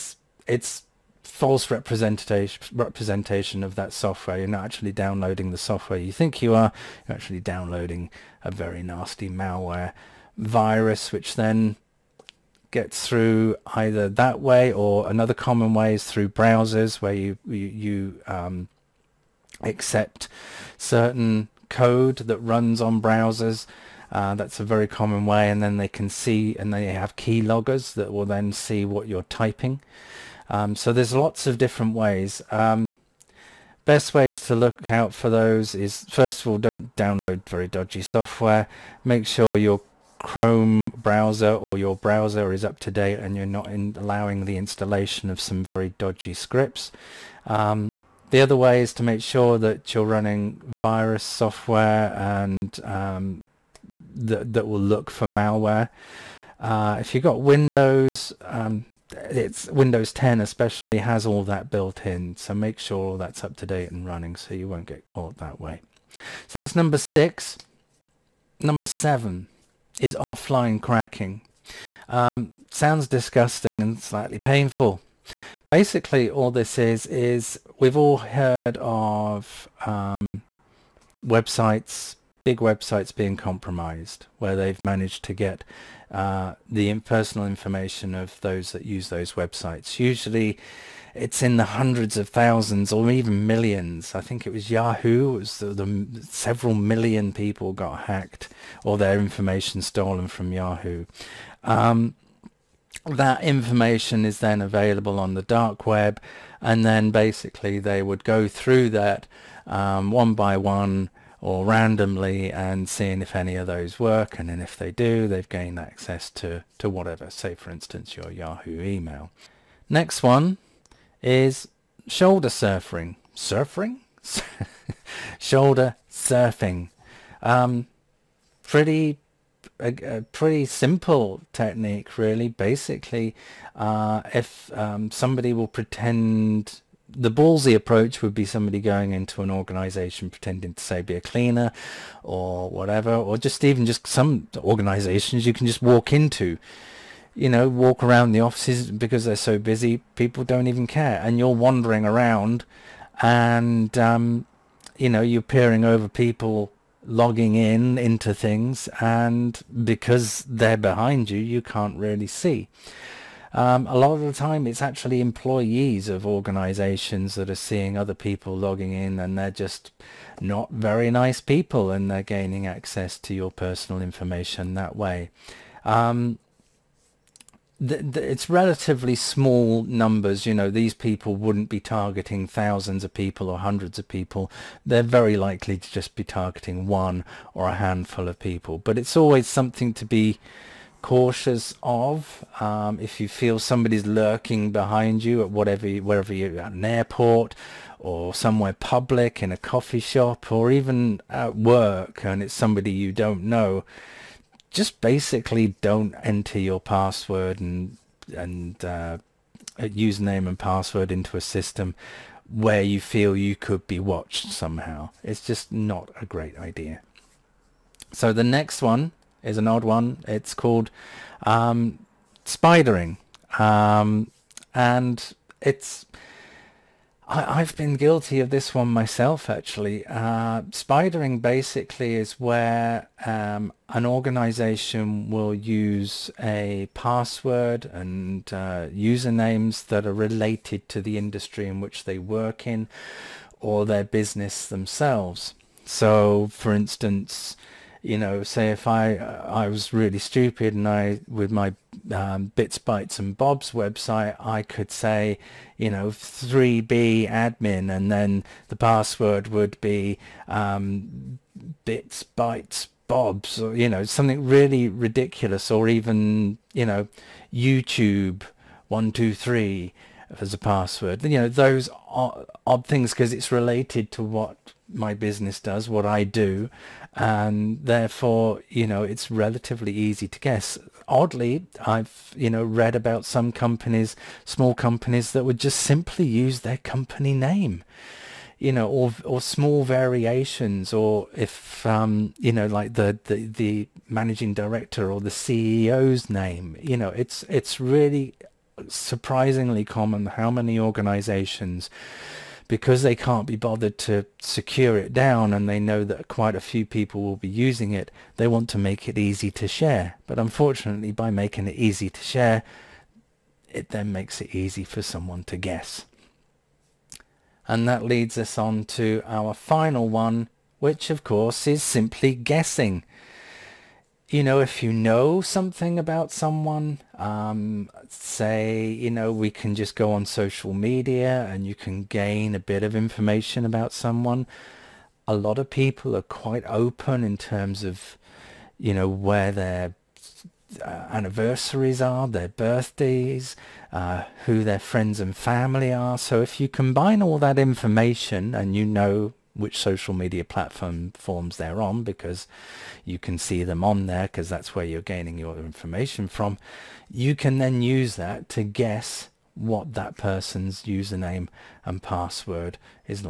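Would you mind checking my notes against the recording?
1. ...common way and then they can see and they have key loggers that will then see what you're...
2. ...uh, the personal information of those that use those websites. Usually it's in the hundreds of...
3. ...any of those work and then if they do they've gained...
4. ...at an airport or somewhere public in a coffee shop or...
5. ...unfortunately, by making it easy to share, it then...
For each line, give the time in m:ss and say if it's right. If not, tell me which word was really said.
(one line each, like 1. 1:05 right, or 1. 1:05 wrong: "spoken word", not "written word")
1. 0:24 right
2. 1:26 right
3. 1:53 right
4. 3:16 right
5. 5:10 right.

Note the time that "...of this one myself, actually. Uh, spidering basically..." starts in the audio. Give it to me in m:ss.
3:48.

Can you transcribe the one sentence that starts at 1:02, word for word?
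So make sure all that's up to date and running so you won't get caught that way.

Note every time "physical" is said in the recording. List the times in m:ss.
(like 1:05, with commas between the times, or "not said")
not said.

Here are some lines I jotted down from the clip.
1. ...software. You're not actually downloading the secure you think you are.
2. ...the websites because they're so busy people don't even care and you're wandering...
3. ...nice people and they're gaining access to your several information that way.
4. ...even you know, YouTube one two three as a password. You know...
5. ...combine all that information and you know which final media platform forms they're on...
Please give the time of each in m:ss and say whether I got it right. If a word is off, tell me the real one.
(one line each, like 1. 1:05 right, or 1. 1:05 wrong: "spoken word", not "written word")
1. 0:03 wrong: "software", not "secure"
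2. 2:28 wrong: "offices", not "websites"
3. 2:51 wrong: "personal", not "several"
4. 4:25 right
5. 5:46 wrong: "social", not "final".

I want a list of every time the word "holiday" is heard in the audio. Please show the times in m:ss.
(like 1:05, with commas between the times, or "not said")
not said.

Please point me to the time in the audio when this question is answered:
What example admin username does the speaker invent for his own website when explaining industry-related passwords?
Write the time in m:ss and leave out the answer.
4:16.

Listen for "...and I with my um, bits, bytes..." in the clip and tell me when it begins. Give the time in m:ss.
4:10.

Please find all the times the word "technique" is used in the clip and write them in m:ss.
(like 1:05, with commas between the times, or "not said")
2:11.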